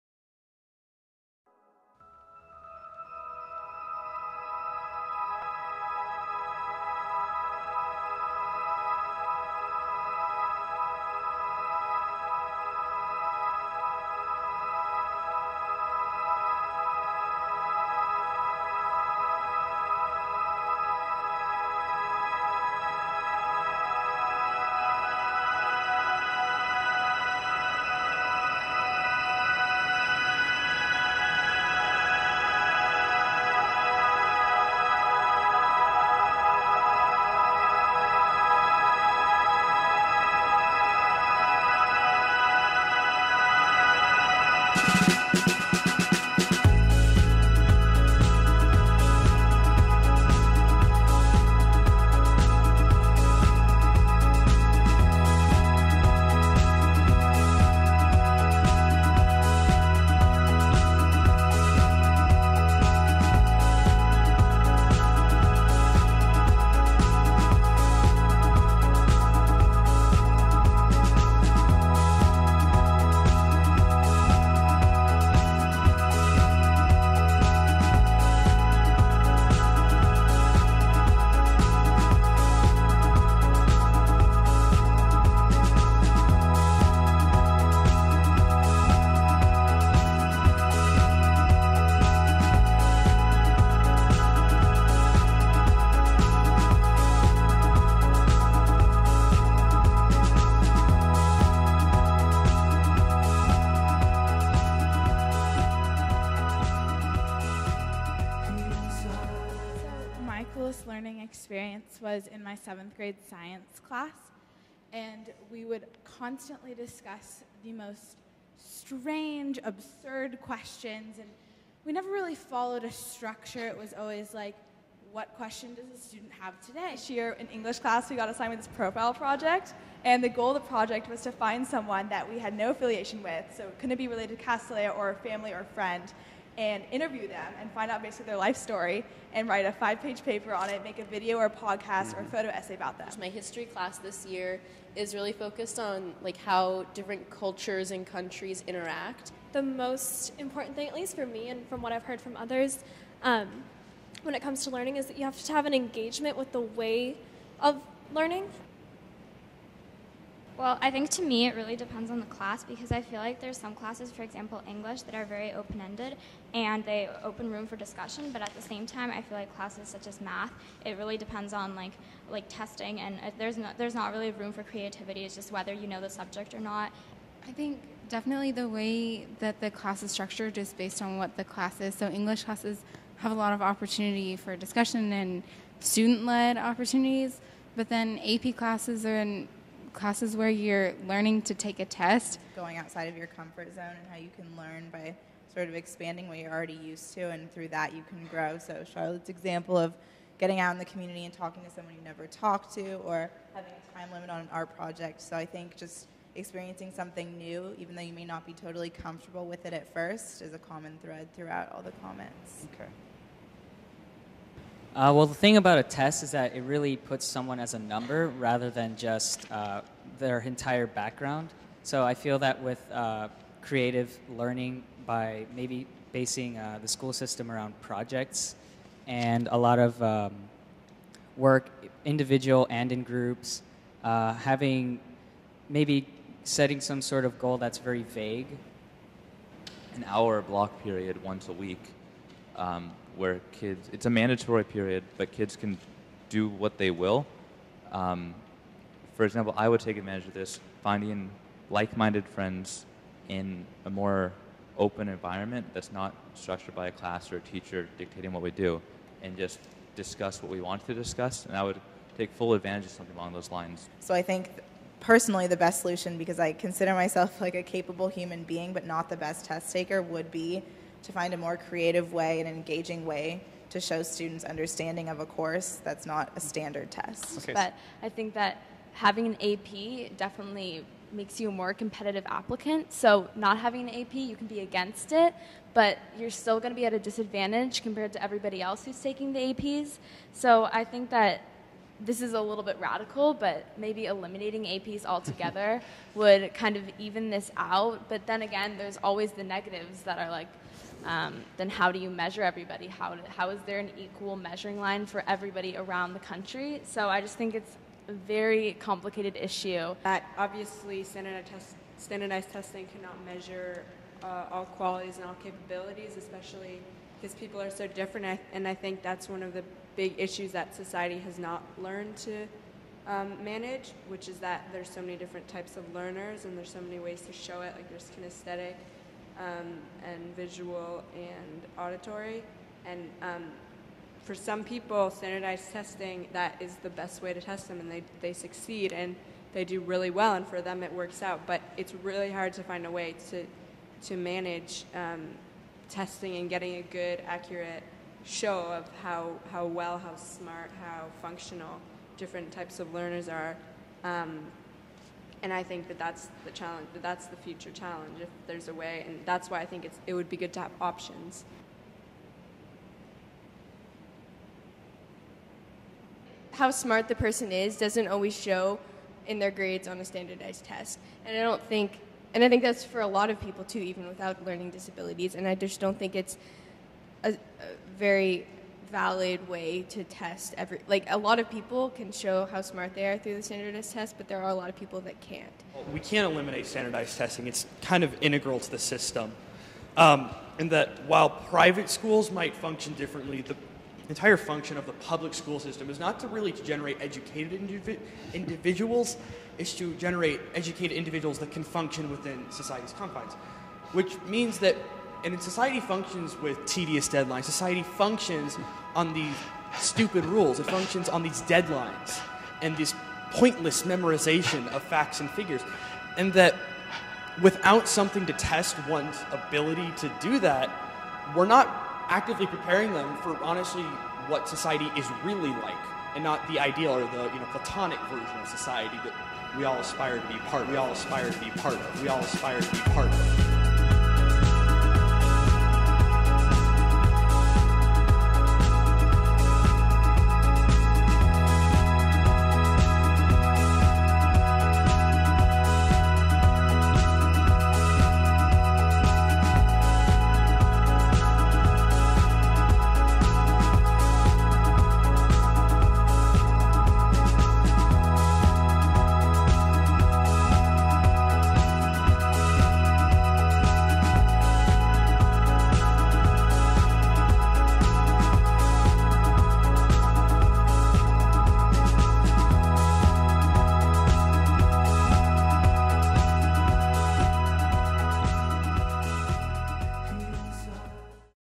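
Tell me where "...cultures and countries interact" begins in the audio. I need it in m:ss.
2:27.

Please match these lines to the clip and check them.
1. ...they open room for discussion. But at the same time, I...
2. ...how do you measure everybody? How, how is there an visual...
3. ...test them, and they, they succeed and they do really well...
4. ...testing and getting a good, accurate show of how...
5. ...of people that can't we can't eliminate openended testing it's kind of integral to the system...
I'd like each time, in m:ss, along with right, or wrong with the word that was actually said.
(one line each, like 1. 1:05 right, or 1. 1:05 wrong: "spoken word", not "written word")
1. 2:46 right
2. 5:01 wrong: "equal", not "visual"
3. 5:37 right
4. 5:45 right
5. 6:24 wrong: "standardized", not "openended".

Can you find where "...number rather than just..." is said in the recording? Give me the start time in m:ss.
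3:37.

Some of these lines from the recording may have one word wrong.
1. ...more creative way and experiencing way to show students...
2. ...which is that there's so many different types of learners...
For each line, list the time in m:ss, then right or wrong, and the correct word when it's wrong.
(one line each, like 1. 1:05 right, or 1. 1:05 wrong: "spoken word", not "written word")
1. 4:31 wrong: "engaging", not "experiencing"
2. 5:24 right.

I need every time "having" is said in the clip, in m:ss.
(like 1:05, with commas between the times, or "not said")
3:23, 3:54, 4:38, 4:43.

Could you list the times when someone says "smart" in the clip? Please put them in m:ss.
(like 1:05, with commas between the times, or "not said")
5:50, 6:06, 6:22.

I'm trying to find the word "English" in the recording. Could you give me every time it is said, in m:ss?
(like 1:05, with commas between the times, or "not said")
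2:07, 2:44, 3:02.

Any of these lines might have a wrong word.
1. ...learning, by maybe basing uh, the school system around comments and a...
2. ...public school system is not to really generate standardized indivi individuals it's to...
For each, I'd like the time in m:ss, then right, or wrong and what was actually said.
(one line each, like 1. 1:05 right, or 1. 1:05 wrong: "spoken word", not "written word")
1. 3:44 wrong: "projects", not "comments"
2. 6:34 wrong: "educated", not "standardized".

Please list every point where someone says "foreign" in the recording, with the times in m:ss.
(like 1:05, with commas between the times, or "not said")
not said.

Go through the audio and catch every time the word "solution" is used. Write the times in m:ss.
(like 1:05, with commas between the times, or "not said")
4:25.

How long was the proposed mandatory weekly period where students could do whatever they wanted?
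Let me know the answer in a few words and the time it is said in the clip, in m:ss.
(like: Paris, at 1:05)
An hour, at 3:59.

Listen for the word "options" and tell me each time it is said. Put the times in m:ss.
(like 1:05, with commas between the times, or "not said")
6:00.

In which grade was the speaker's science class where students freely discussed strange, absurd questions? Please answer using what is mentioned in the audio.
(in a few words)
Seventh grade.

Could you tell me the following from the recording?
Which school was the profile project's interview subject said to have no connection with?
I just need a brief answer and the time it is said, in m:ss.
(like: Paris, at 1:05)
Castilleja, at 2:14.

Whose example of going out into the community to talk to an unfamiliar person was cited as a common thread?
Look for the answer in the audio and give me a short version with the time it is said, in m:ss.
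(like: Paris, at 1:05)
Charlotte, at 3:18.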